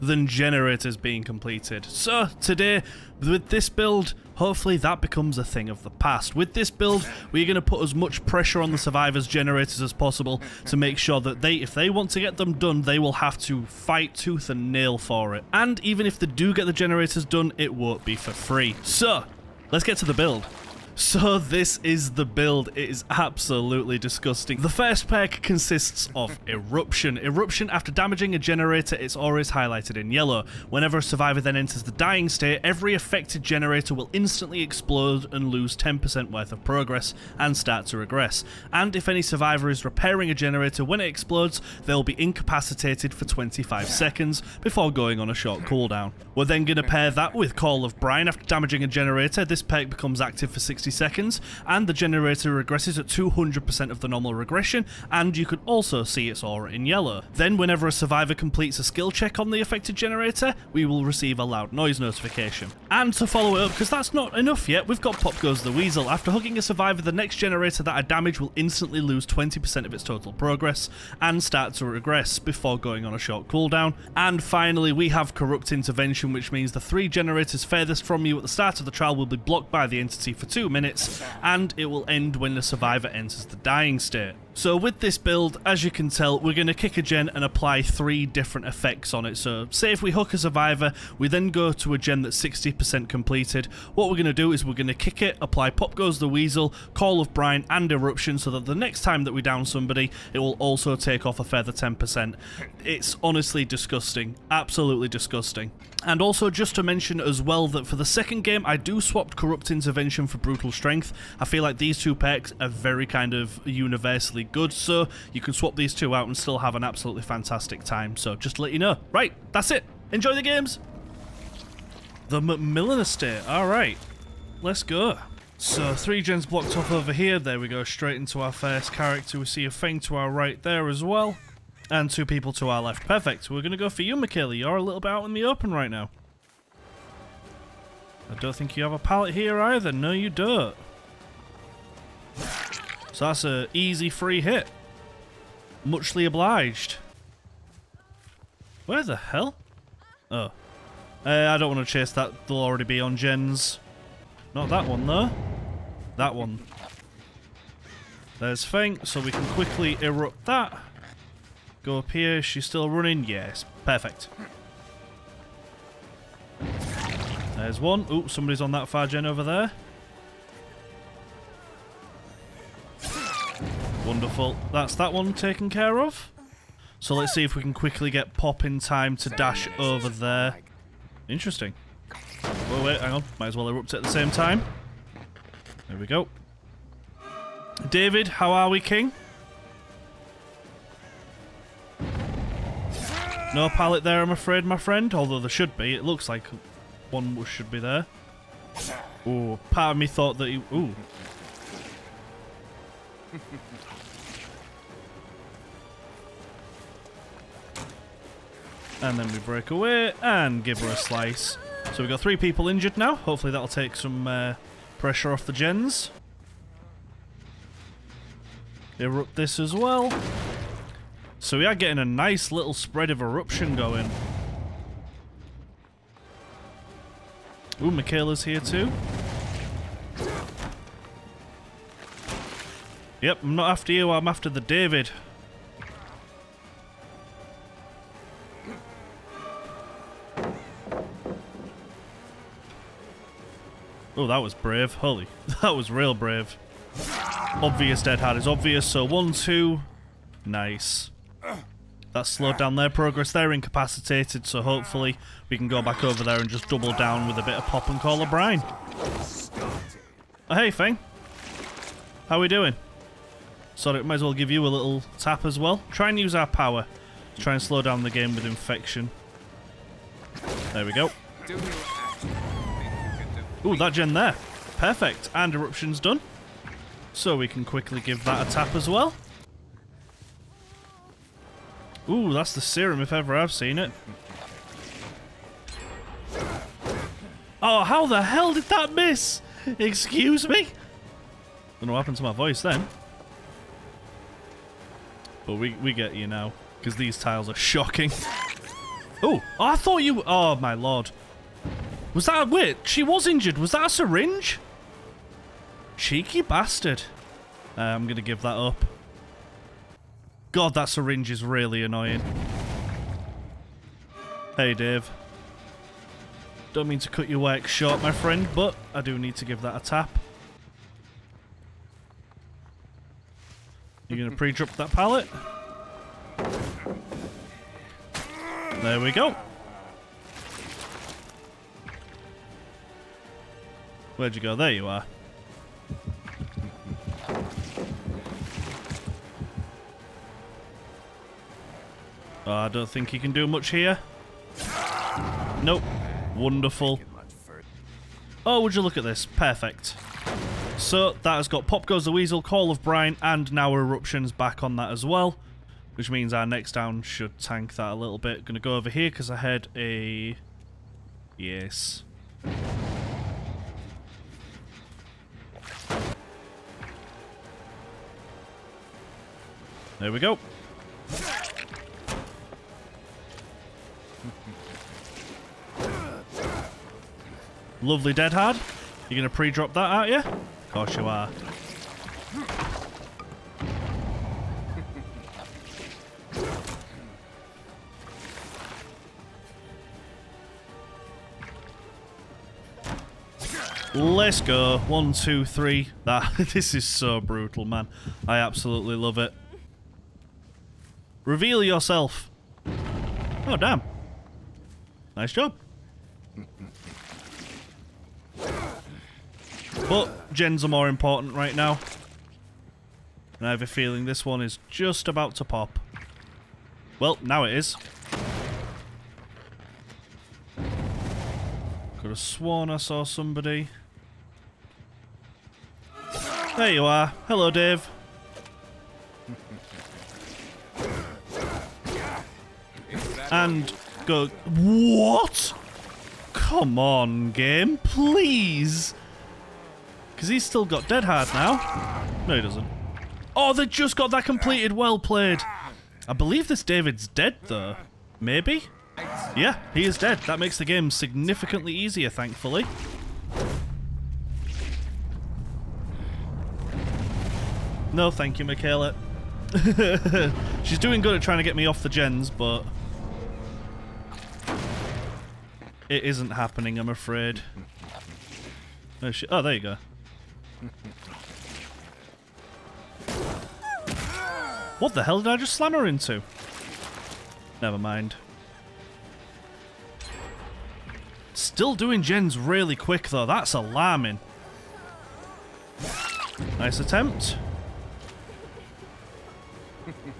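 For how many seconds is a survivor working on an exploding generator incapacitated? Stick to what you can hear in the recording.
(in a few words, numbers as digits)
25 seconds.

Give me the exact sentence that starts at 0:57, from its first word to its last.
Then whenever a survivor completes a skill check on the affected generator, we will receive a loud noise notification.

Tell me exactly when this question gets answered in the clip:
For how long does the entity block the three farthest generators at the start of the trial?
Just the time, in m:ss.
1:20.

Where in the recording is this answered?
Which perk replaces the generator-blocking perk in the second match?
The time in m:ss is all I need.
1:50.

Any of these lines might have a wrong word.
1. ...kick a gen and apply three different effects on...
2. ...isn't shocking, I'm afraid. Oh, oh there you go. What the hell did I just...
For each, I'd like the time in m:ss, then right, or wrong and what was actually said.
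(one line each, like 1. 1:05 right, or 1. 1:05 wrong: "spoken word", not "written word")
1. 1:26 right
2. 7:46 wrong: "happening", not "shocking".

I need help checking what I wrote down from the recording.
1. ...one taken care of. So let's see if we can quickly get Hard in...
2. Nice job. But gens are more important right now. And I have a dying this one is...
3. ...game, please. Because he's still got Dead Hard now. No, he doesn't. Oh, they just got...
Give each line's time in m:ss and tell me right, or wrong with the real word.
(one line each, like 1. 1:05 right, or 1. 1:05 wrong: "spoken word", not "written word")
1. 2:55 wrong: "Pop", not "Hard"
2. 6:45 wrong: "feeling", not "dying"
3. 7:17 right.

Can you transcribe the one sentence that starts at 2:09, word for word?
We see a thing to our right there as well.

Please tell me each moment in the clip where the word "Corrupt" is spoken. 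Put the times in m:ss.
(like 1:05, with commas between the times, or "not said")
1:15, 1:49.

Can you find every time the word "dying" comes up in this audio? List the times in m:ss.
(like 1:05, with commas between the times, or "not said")
0:31, 1:23.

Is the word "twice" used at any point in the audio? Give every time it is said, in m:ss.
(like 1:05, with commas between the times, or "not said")
not said.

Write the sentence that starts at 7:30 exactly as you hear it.
That makes the game significantly easier, thankfully.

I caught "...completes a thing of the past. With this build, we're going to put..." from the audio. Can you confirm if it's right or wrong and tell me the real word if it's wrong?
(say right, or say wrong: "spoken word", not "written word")
wrong: "becomes", not "completes".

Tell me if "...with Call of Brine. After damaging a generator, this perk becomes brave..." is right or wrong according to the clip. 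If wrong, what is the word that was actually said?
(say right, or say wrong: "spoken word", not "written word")
wrong: "active", not "brave".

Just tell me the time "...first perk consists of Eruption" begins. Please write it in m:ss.
0:24.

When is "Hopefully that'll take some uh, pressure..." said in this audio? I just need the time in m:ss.
3:33.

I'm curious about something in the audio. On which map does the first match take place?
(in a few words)
The Macmillan Estate.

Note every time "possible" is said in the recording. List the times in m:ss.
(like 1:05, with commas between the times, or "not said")
0:09.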